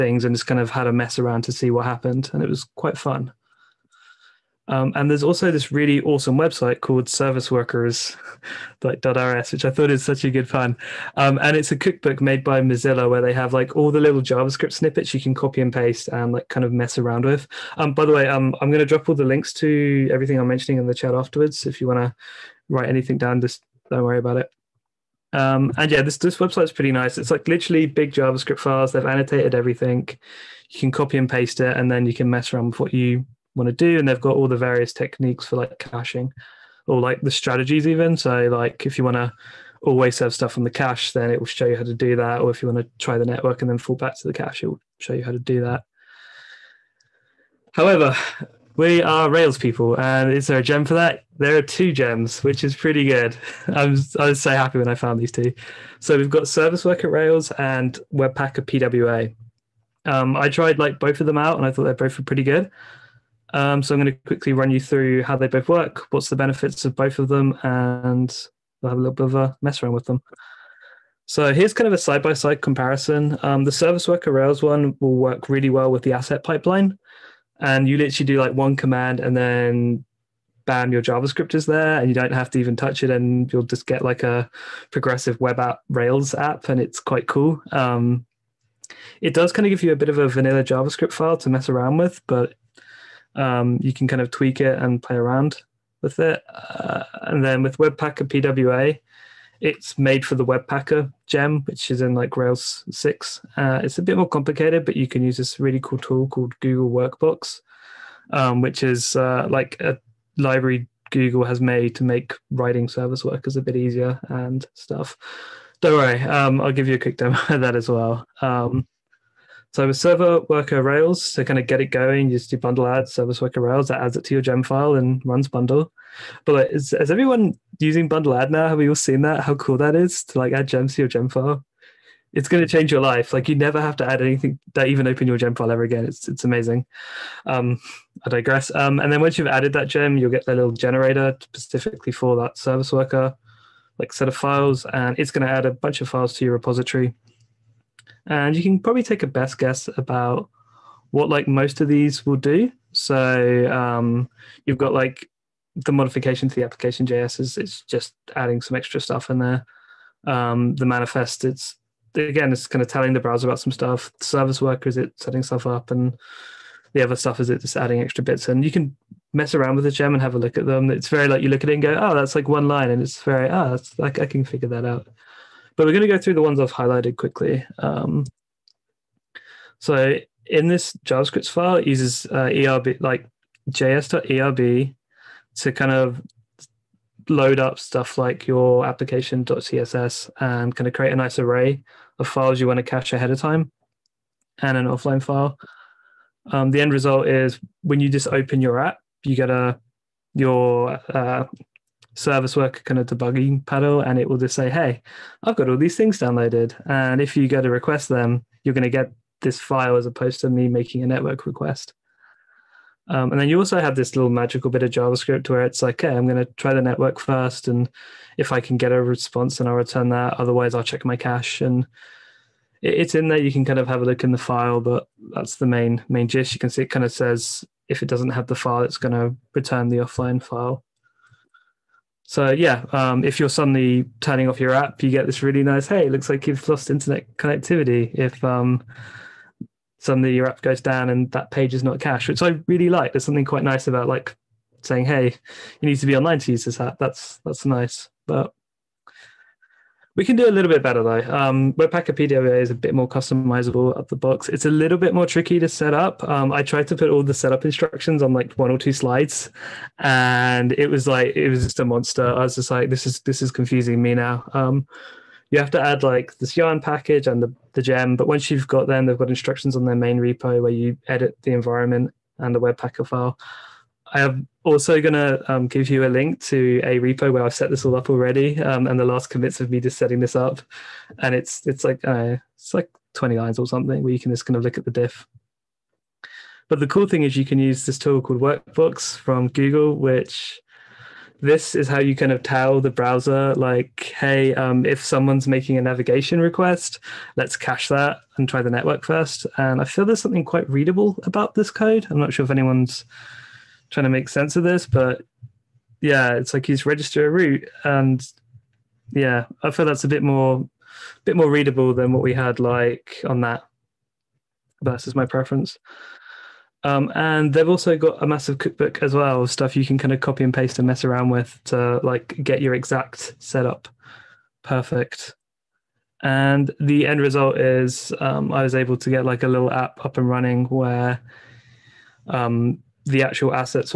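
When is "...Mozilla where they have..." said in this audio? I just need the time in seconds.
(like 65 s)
12 s.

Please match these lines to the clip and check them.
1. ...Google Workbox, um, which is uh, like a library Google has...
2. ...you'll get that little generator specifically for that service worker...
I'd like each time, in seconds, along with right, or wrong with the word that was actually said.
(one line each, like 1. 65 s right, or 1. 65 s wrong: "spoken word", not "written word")
1. 106 s right
2. 140 s right.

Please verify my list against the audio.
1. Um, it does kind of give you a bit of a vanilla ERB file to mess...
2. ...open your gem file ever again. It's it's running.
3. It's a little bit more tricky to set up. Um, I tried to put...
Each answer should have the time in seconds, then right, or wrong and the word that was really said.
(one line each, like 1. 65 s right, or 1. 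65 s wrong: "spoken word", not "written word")
1. 87 s wrong: "JavaScript", not "ERB"
2. 135 s wrong: "amazing", not "running"
3. 254 s right.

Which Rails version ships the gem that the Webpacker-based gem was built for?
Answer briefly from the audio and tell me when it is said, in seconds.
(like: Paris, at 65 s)
Rails 6, at 102 s.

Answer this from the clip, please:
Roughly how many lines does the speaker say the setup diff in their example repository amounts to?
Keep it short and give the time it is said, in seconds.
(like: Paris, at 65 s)
20, at 283 s.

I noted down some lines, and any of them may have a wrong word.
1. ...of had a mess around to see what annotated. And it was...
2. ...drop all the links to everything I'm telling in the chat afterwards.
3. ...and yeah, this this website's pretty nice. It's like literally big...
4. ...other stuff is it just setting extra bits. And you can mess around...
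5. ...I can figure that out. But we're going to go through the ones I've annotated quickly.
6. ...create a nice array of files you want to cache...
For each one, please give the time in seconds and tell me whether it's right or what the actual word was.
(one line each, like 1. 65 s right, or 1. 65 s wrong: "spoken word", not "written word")
1. 0 s wrong: "happened", not "annotated"
2. 18 s wrong: "mentioning", not "telling"
3. 25 s right
4. 167 s wrong: "adding", not "setting"
5. 174 s wrong: "highlighted", not "annotated"
6. 190 s right.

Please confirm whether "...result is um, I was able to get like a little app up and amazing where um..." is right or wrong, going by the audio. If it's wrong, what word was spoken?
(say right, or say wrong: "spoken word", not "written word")
wrong: "running", not "amazing".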